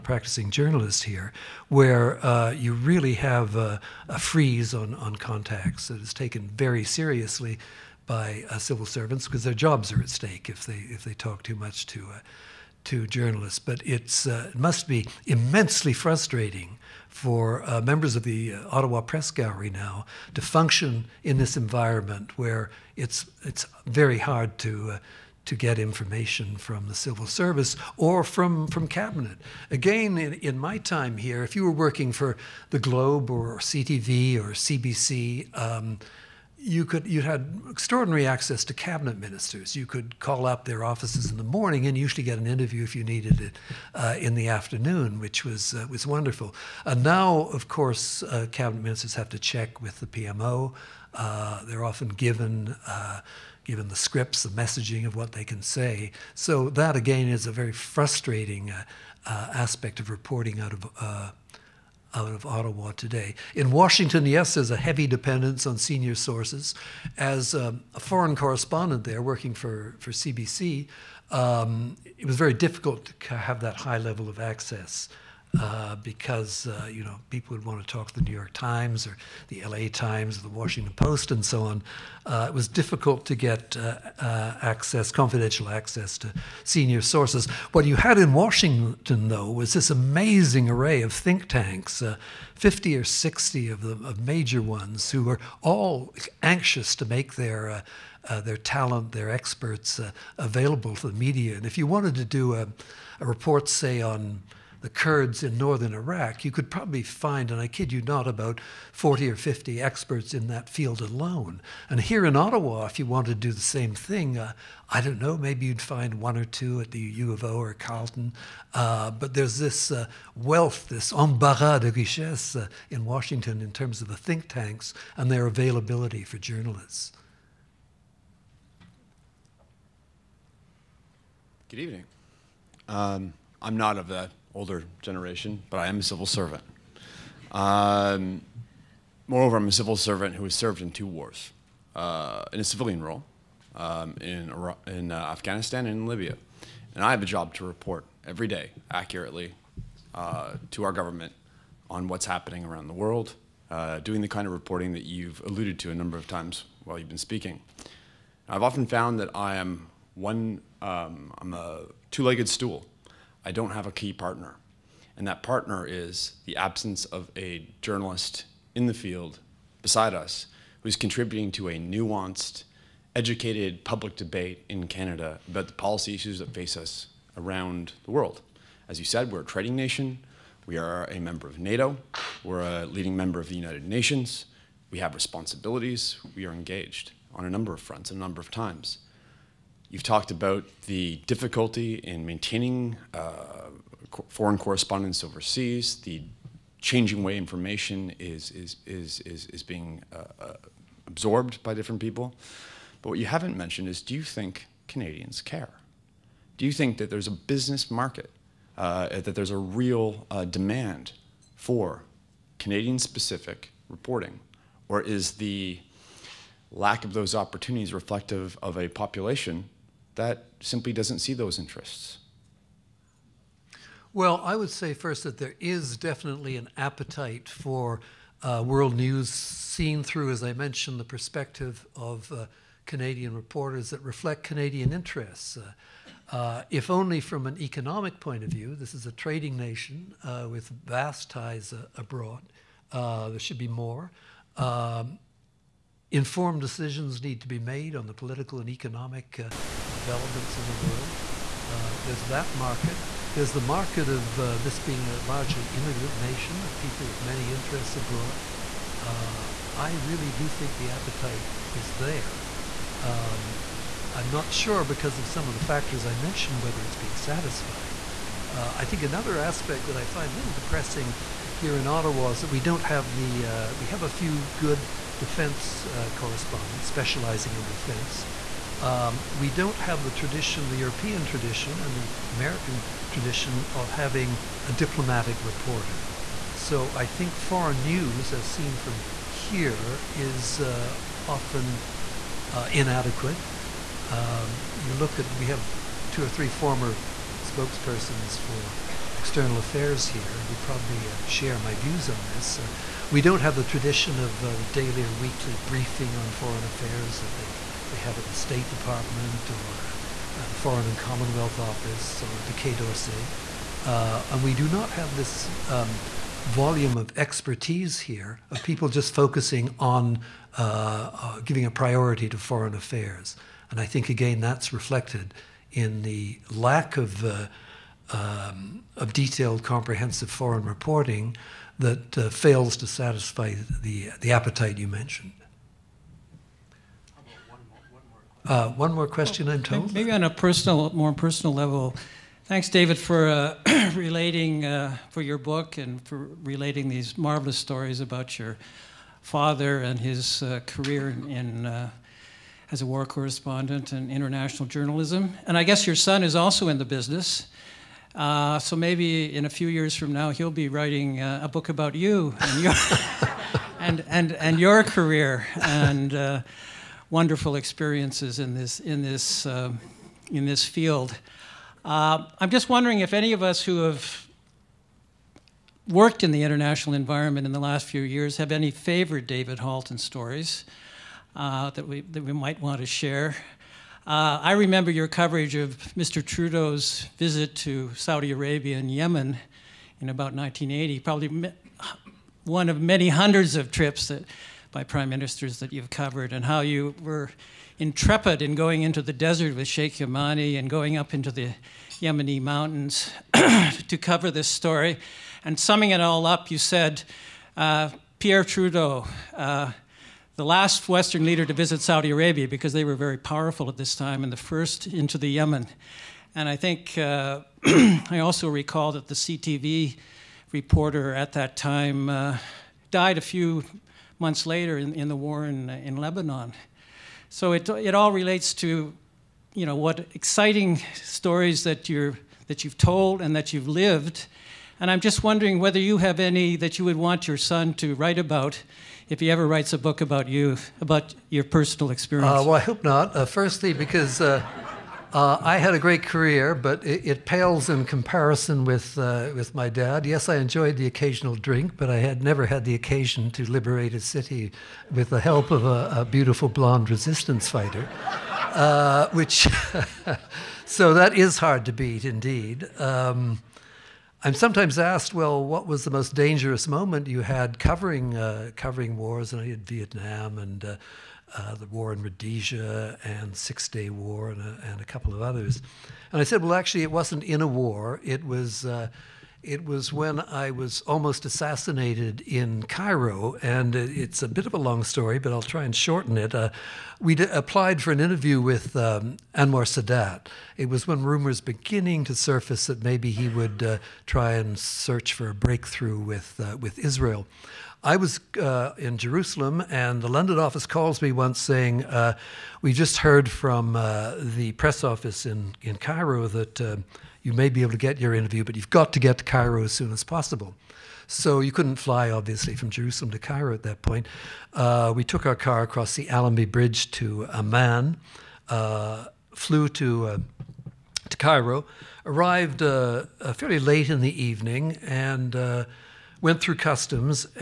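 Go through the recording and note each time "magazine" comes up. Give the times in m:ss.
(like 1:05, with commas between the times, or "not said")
not said.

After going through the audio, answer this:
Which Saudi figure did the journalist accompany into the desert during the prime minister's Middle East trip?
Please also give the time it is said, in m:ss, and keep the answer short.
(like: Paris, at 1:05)
Sheikh Yamani, at 6:39.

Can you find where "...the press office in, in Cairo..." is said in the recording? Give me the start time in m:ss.
8:24.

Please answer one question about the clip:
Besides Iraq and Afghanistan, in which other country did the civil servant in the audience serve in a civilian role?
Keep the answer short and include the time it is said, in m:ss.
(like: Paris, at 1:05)
Libya, at 2:26.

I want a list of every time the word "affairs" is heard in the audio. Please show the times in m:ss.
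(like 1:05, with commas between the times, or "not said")
4:59, 5:06, 5:22.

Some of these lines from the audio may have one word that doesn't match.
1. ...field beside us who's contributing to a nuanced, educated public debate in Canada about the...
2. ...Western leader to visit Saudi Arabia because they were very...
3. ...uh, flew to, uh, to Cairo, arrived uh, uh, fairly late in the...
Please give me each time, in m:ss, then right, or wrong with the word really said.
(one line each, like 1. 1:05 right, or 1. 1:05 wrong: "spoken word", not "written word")
1. 2:48 right
2. 6:50 right
3. 8:38 right.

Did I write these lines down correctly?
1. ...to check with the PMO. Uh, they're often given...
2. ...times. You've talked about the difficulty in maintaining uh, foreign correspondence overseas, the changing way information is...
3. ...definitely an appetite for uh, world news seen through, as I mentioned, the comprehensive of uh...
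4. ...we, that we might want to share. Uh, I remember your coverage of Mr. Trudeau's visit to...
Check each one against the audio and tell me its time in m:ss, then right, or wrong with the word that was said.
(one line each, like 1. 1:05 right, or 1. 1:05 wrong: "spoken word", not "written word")
1. 0:49 right
2. 3:08 right
3. 3:45 wrong: "perspective", not "comprehensive"
4. 6:21 right.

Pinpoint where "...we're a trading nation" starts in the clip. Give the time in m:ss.
2:59.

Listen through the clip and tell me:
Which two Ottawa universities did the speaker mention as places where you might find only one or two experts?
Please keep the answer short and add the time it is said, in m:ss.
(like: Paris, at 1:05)
U of O or Carleton, at 1:56.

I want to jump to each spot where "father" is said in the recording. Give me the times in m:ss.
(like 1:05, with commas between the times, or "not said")
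5:49.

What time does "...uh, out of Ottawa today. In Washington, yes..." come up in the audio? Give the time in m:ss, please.
1:00.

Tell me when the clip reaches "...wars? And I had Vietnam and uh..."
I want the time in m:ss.
7:48.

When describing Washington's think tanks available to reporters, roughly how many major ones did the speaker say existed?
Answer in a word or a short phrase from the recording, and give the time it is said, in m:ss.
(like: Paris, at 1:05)
50 or 60, at 1:32.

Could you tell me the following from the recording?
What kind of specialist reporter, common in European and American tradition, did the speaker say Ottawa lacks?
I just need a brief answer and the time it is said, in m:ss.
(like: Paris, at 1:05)
diplomatic reporter, at 4:44.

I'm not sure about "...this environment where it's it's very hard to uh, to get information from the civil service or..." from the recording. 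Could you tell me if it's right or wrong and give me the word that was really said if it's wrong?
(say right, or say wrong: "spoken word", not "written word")
right.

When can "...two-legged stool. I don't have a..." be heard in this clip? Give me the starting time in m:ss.
2:42.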